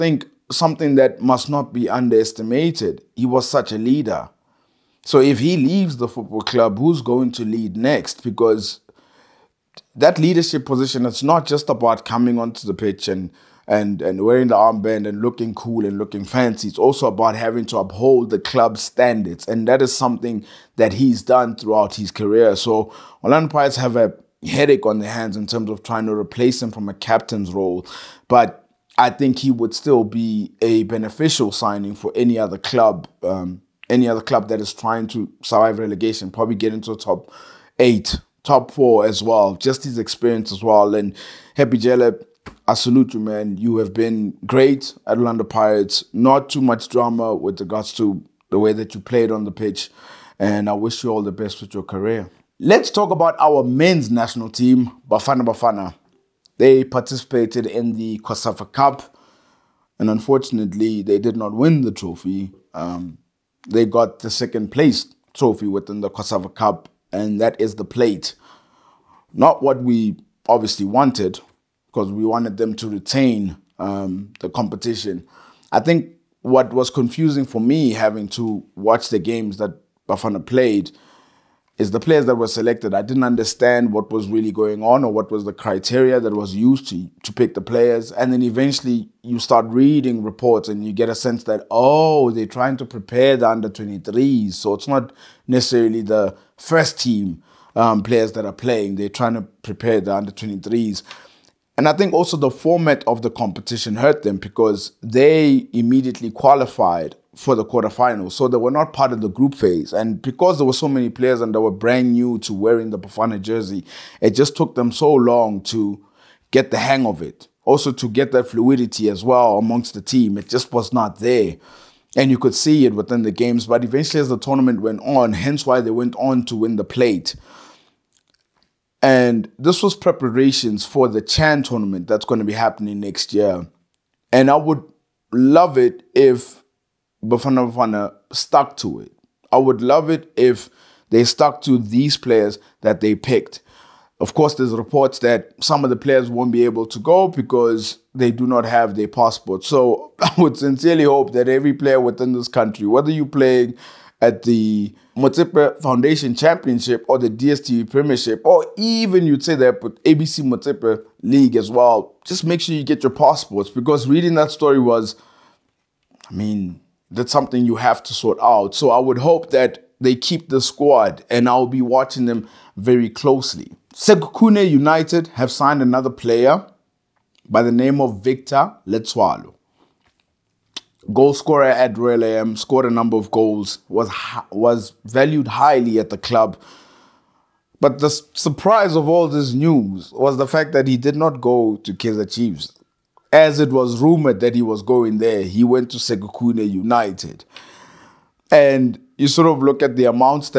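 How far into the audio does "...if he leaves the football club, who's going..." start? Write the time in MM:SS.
00:05.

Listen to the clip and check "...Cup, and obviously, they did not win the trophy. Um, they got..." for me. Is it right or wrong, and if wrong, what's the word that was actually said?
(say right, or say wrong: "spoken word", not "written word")
wrong: "unfortunately", not "obviously".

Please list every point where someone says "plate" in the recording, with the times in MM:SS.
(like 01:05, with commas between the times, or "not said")
01:07, 02:06.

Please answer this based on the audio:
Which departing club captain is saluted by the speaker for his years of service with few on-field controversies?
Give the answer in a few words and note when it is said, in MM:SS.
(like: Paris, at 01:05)
Happy Jele, at 00:41.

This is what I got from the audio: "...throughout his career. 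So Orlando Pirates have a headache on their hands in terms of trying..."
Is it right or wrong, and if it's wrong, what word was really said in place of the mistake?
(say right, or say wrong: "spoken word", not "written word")
right.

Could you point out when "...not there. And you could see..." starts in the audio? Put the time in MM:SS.
02:00.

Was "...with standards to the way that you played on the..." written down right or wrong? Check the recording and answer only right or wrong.
wrong.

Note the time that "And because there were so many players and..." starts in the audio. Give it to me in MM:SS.
01:49.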